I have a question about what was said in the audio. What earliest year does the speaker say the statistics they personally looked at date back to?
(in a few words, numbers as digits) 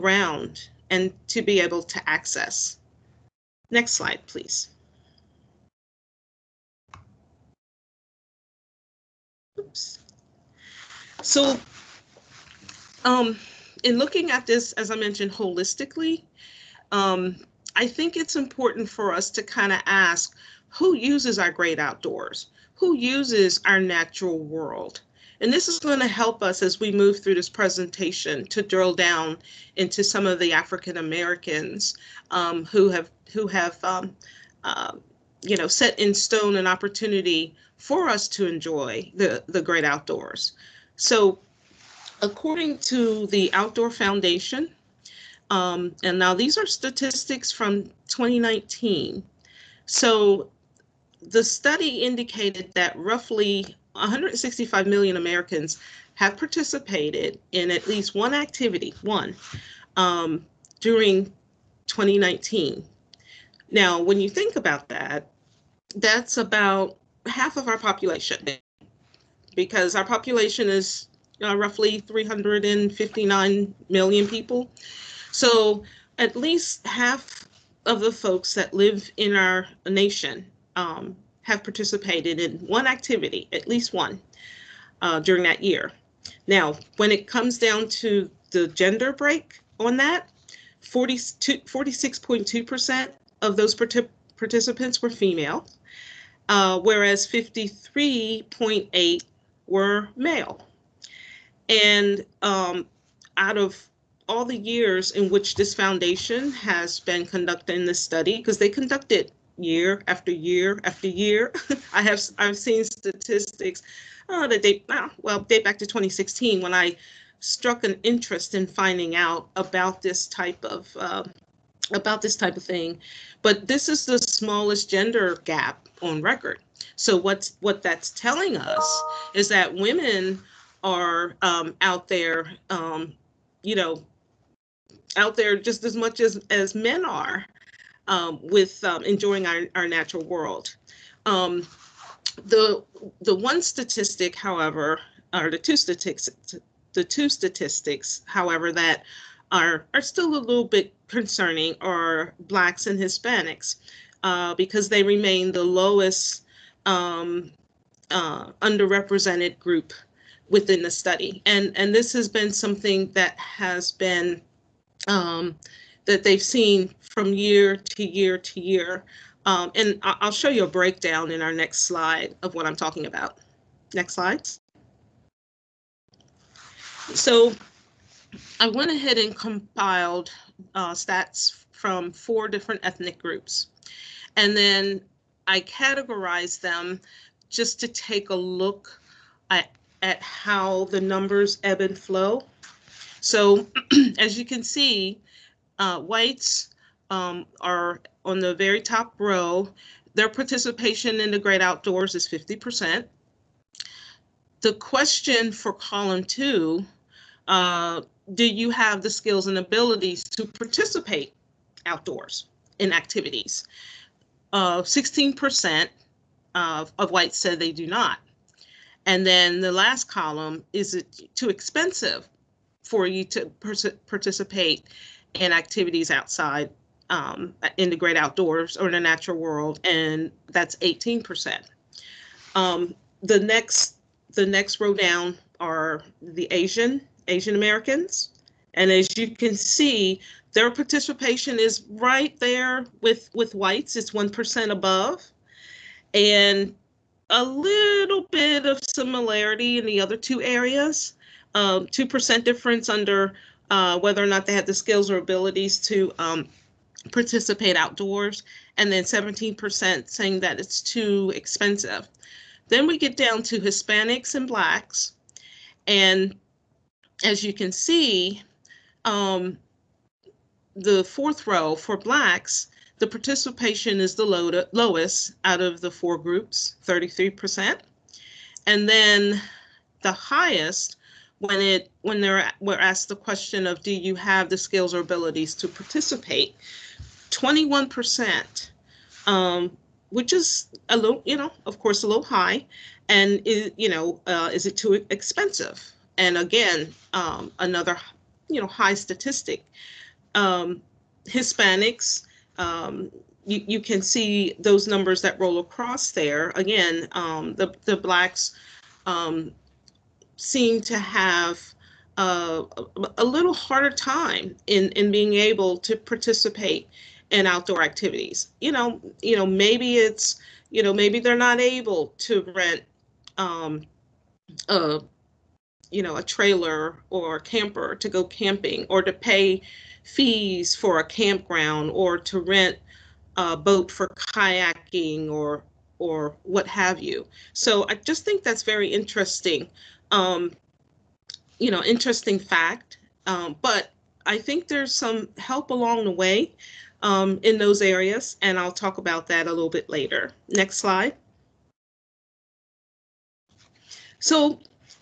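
2016.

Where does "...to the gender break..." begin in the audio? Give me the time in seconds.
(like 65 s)
87 s.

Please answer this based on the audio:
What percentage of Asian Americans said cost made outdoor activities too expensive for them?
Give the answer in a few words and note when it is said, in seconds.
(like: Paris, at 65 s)
17%, at 259 s.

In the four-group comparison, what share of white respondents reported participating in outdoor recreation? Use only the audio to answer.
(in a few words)
50%.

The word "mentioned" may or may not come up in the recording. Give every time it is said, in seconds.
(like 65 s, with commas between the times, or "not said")
14 s.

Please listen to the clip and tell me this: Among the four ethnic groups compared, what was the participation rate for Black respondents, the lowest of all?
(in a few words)
33%.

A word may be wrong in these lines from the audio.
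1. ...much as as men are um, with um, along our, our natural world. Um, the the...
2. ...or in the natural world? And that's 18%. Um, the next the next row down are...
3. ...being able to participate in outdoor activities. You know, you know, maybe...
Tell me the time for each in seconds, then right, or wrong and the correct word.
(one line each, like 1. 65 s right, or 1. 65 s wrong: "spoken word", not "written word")
1. 135 s wrong: "enjoying", not "along"
2. 228 s right
3. 315 s right.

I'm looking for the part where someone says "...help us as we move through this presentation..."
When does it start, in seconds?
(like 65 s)
26 s.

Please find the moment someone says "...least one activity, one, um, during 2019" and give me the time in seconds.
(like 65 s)
57 s.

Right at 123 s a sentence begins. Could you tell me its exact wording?
But this is the smallest gender gap on record.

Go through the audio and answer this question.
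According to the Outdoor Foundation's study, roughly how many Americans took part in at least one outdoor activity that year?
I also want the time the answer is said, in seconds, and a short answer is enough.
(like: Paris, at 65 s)
165 million, at 53 s.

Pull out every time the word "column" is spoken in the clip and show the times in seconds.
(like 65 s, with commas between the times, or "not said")
205 s, 220 s.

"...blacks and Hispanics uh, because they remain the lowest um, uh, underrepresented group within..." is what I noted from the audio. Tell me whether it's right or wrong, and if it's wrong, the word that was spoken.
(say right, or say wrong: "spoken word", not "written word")
right.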